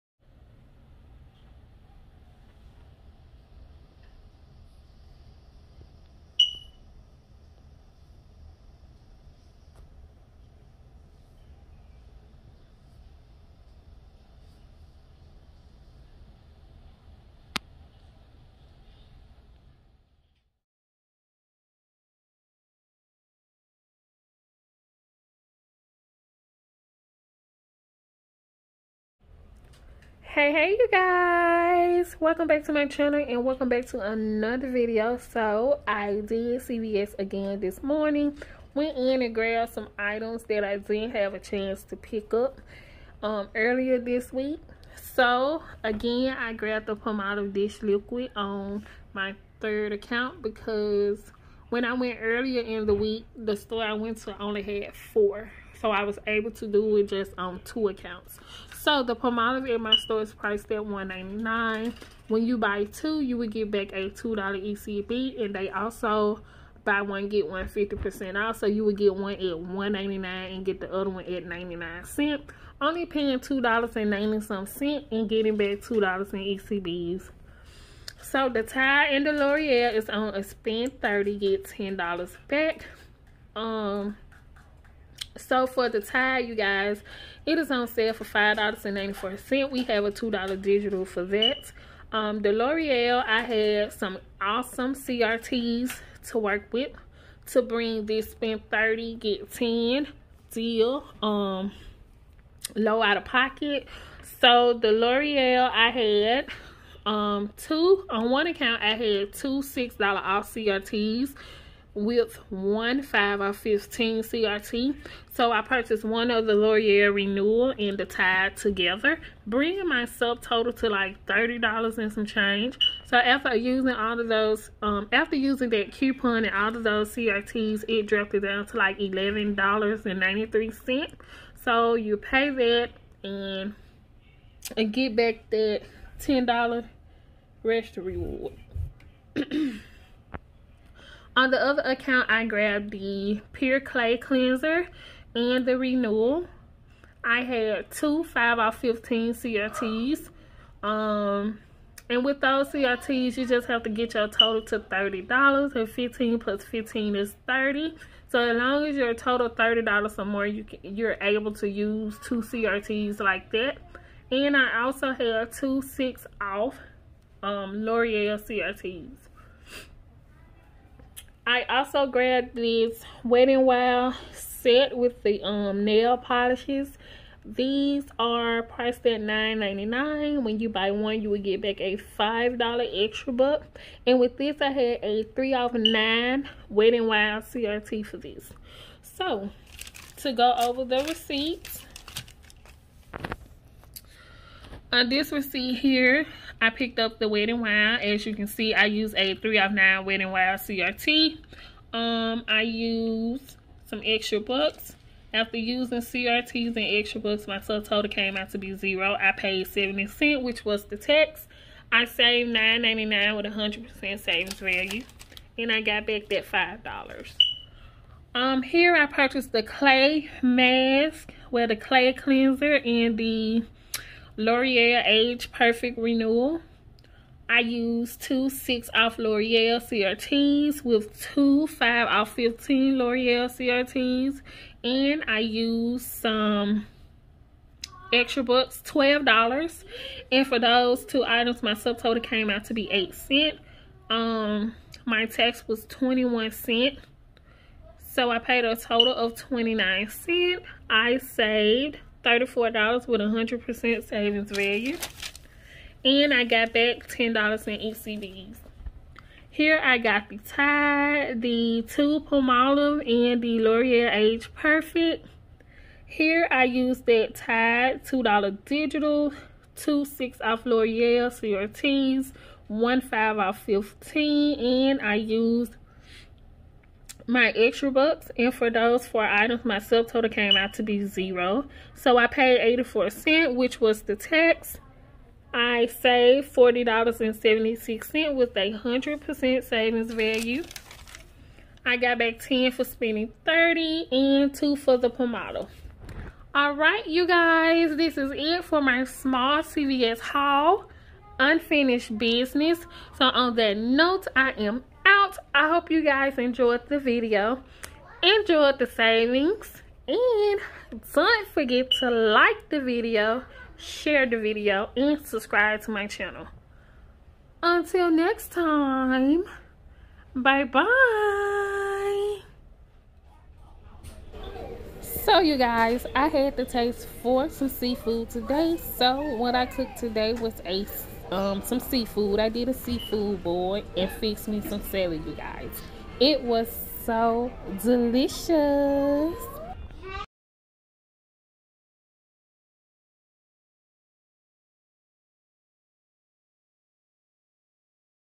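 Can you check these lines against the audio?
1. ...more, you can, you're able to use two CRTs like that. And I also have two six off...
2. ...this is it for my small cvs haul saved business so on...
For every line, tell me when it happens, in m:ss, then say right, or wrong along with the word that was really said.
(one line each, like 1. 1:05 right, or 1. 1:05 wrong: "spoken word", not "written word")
1. 2:40 right
2. 4:57 wrong: "unfinished", not "saved".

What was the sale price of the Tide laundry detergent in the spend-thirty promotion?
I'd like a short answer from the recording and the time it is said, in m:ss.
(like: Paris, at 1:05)
$5.94, at 1:28.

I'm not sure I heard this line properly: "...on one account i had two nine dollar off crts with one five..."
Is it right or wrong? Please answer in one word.
wrong.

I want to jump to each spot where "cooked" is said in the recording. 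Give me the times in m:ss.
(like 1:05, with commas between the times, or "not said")
5:29.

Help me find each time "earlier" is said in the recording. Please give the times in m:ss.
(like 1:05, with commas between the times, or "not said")
0:43, 0:52.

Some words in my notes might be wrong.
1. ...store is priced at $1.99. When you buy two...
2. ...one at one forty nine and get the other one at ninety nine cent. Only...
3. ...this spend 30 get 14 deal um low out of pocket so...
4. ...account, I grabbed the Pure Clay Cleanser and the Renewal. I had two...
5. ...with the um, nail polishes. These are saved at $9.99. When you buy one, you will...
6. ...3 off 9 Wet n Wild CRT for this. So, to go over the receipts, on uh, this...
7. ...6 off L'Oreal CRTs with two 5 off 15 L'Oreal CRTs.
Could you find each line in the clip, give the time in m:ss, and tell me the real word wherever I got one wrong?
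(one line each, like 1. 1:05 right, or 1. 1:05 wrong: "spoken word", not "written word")
1. 0:59 right
2. 1:09 wrong: "ninety", not "forty"
3. 1:38 wrong: "10", not "14"
4. 2:21 right
5. 2:54 wrong: "priced", not "saved"
6. 3:05 right
7. 3:48 right.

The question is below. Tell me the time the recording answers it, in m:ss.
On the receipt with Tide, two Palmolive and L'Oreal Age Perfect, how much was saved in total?
4:46.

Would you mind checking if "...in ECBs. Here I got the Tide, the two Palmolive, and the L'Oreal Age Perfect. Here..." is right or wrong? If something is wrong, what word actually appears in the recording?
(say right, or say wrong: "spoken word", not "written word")
right.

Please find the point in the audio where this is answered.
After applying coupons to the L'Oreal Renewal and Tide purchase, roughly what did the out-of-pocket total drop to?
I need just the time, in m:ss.
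2:08.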